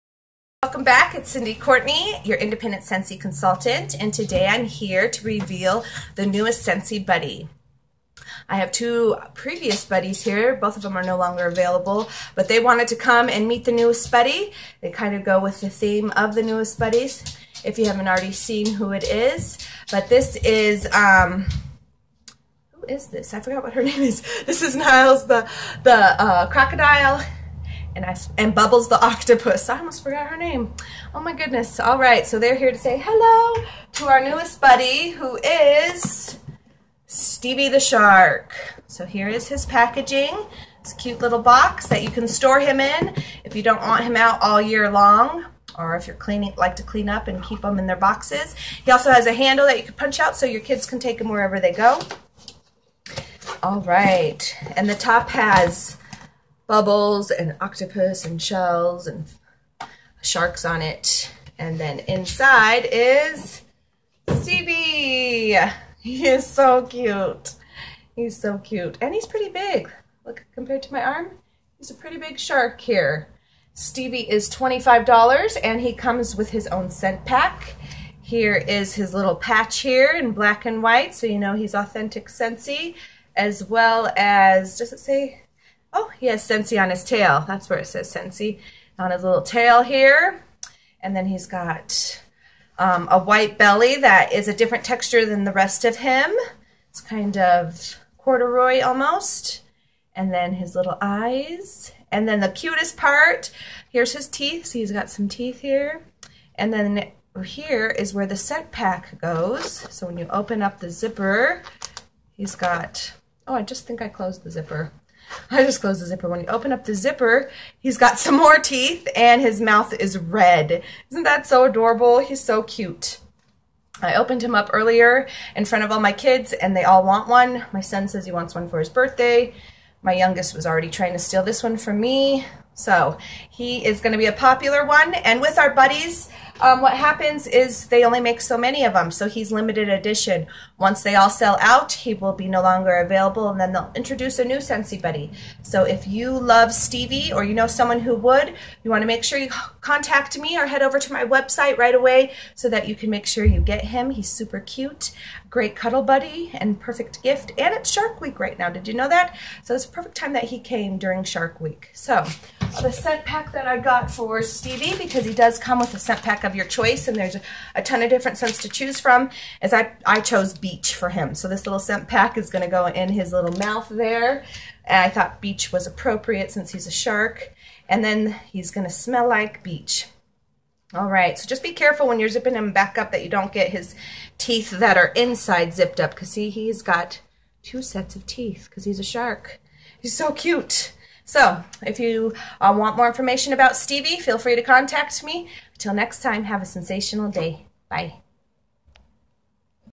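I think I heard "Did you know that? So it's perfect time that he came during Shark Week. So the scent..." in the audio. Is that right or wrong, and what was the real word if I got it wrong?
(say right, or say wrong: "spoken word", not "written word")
right.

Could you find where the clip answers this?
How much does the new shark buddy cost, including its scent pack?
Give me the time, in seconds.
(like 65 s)
74 s.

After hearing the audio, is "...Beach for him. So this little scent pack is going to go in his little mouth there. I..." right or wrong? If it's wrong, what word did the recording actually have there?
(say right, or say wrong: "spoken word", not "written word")
right.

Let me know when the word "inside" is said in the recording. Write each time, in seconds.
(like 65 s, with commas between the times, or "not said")
62 s, 185 s.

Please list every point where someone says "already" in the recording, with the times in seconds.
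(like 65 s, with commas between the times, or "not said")
18 s, 130 s.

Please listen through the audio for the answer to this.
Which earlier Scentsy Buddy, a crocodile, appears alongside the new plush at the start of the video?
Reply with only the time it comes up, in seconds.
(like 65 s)
24 s.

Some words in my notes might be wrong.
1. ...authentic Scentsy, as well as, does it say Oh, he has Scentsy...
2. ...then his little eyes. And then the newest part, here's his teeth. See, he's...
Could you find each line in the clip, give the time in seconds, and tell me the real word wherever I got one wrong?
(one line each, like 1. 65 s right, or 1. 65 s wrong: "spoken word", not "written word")
1. 81 s right
2. 100 s wrong: "cutest", not "newest".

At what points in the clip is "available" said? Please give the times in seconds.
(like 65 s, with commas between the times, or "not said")
11 s, 142 s.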